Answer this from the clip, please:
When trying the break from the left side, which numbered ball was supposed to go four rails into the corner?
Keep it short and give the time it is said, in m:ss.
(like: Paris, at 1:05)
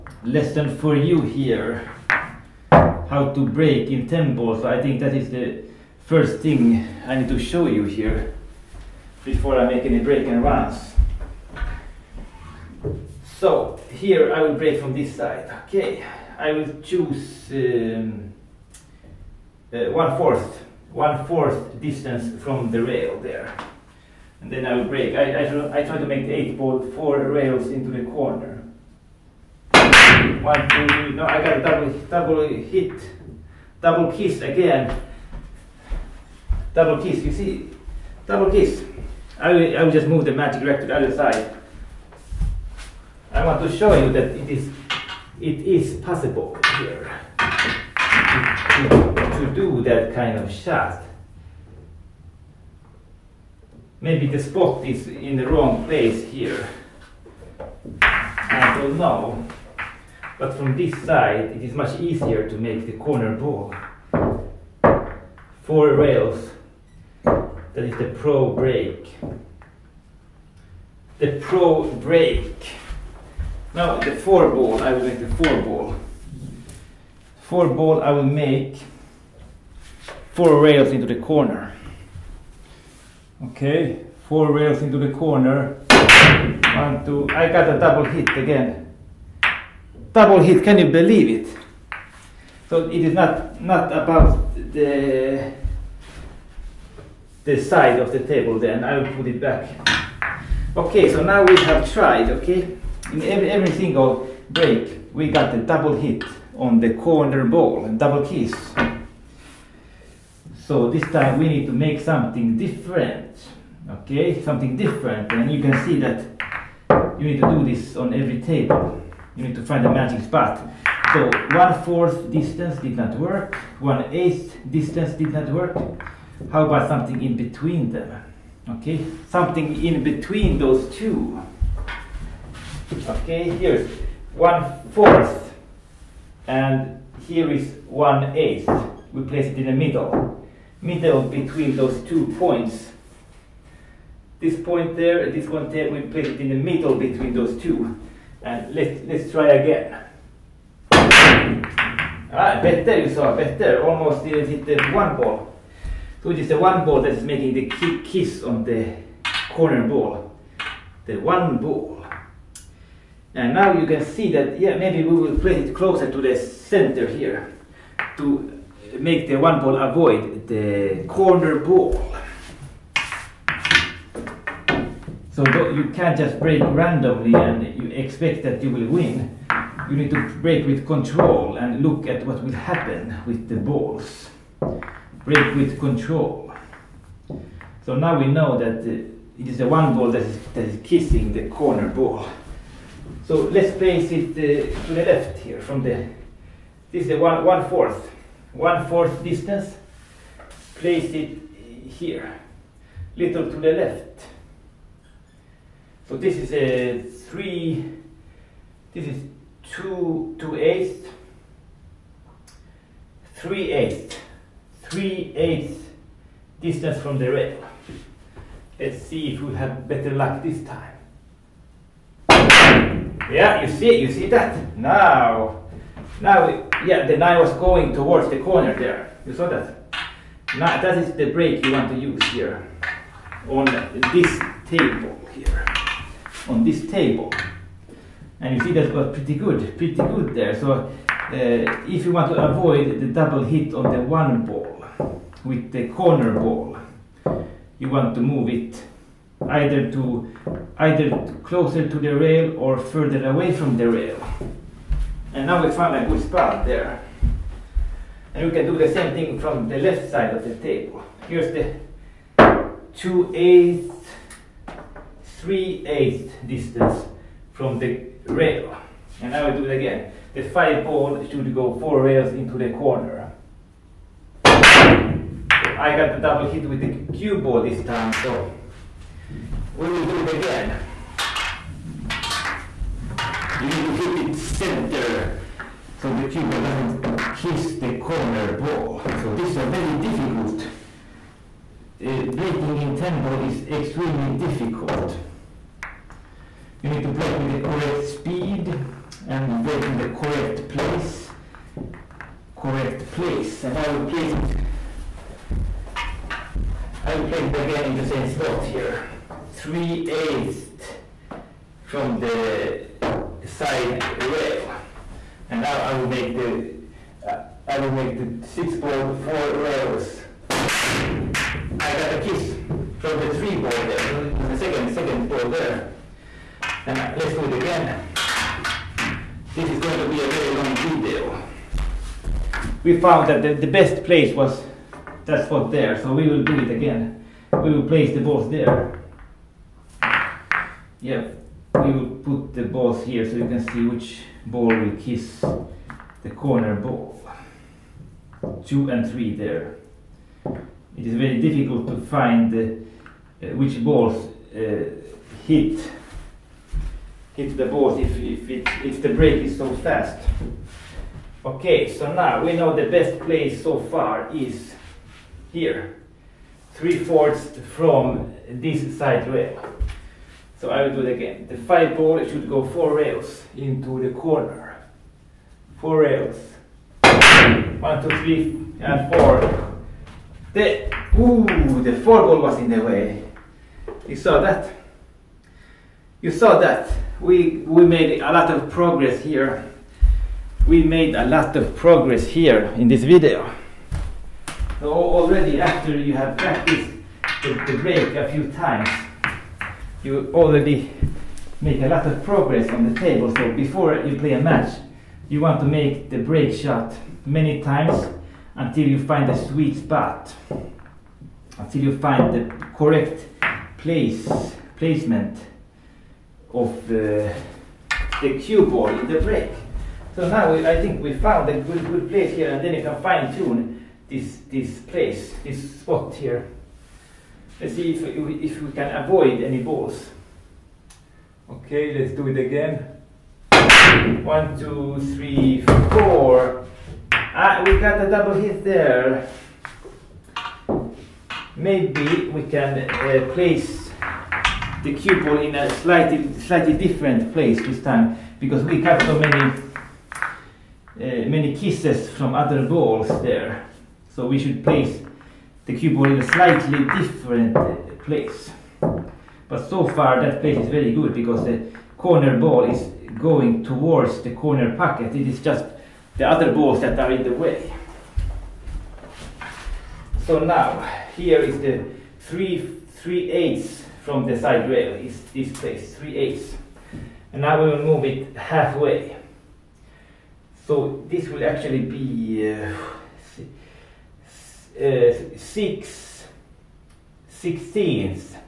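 5 ball, at 4:30.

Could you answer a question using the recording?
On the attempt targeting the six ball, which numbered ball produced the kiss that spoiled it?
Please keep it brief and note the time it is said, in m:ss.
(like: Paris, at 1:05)
3 ball, at 5:23.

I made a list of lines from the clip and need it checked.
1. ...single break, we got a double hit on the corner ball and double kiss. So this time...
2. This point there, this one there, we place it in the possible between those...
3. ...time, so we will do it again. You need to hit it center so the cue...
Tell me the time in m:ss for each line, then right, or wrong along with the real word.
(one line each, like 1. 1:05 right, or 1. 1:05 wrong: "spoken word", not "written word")
1. 1:43 right
2. 2:24 wrong: "middle", not "possible"
3. 4:37 right.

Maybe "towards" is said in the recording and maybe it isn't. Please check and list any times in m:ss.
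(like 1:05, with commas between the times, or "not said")
3:47, 7:43.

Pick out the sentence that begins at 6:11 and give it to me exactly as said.
The five ball, should go four rails into the corner.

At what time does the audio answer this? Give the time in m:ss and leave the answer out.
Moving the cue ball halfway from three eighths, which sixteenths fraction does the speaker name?
8:05.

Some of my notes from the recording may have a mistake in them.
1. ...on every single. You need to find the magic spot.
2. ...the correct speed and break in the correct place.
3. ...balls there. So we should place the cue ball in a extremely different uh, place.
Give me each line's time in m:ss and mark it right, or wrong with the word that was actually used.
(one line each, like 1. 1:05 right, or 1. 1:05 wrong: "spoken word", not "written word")
1. 1:57 wrong: "table", not "single"
2. 4:57 right
3. 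7:32 wrong: "slightly", not "extremely".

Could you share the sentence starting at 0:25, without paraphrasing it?
I I, try, I try to make the eight ball four rails into the corner.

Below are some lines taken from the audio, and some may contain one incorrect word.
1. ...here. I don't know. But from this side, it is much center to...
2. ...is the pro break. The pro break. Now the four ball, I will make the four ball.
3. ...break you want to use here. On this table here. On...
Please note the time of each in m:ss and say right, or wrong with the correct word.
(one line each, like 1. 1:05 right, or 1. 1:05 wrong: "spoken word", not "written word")
1. 0:56 wrong: "easier", not "center"
2. 1:07 right
3. 3:51 right.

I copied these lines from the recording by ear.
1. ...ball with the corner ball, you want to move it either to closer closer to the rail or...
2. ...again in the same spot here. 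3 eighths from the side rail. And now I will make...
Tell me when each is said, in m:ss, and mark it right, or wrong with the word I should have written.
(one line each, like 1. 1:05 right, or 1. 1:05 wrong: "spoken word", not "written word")
1. 4:04 wrong: "either", not "closer"
2. 5:07 right.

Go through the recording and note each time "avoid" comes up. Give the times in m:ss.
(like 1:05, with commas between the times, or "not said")
2:49, 4:02, 7:09.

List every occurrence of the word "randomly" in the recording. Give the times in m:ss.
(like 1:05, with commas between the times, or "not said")
2:56.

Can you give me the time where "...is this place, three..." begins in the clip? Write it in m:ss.
7:54.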